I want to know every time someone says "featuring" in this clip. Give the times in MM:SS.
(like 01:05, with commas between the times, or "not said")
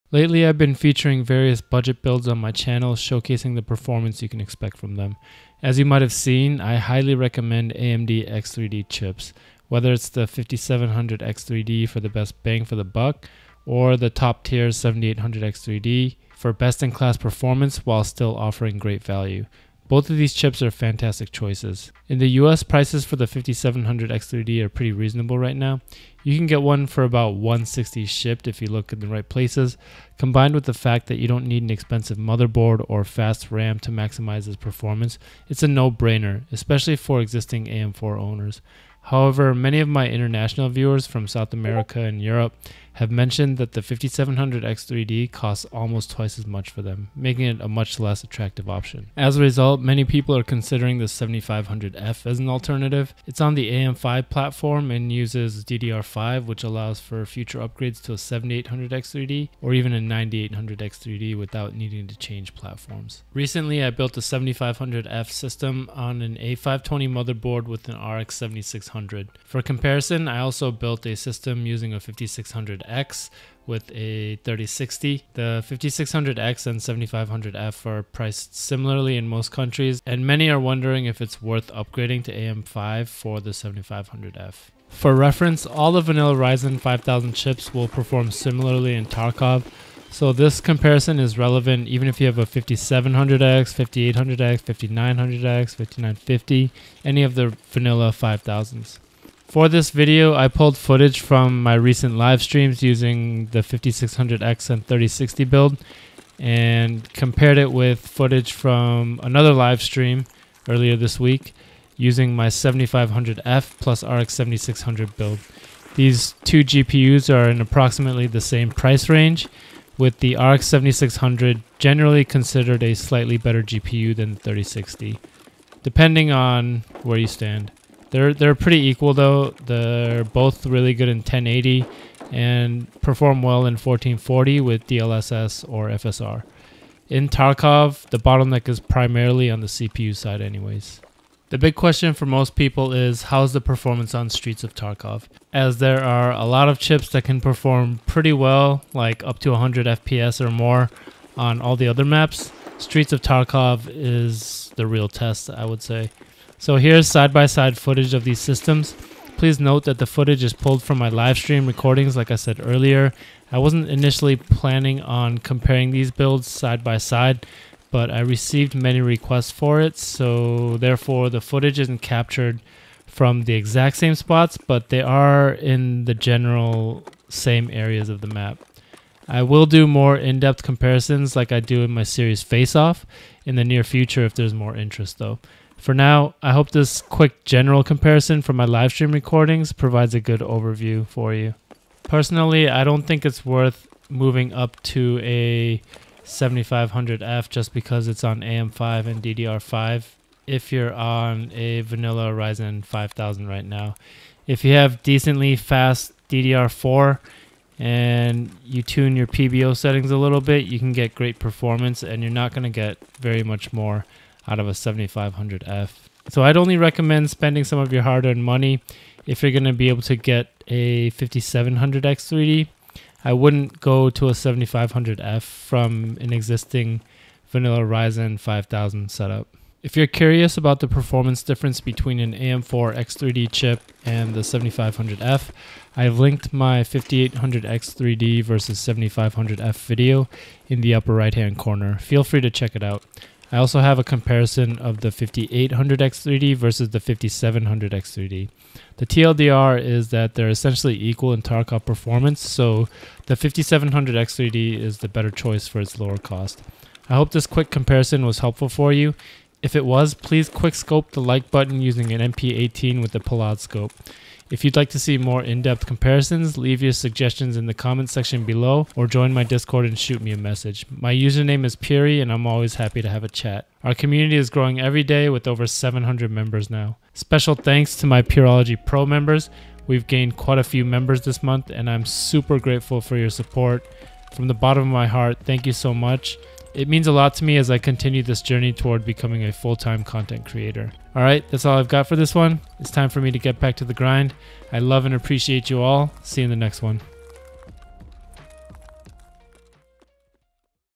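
00:00.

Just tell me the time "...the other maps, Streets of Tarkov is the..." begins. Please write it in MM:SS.
02:31.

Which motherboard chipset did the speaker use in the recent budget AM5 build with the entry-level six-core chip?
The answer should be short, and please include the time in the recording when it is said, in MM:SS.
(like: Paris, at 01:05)
A520, at 01:06.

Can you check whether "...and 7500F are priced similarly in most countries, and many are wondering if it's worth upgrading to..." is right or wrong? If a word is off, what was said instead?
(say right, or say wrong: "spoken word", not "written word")
right.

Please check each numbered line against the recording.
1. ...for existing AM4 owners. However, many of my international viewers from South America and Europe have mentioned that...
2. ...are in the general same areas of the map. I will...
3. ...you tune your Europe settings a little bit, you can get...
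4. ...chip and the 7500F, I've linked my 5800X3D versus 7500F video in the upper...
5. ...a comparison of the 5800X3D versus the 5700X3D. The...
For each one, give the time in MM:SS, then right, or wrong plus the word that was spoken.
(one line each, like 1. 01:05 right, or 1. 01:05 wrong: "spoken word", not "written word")
1. 00:36 right
2. 02:55 right
3. 03:28 wrong: "PBO", not "Europe"
4. 03:53 right
5. 04:03 right.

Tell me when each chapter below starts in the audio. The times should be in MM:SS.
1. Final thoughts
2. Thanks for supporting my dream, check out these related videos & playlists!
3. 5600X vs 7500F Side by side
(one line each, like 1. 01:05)
1. 03:12
2. 04:37
3. 01:24.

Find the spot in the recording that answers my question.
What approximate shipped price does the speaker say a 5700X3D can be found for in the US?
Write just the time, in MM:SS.
00:27.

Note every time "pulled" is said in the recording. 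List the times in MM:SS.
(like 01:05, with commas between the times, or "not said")
01:40, 02:40.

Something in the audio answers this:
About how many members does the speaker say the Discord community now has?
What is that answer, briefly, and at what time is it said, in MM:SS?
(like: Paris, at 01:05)
over 700, at 04:35.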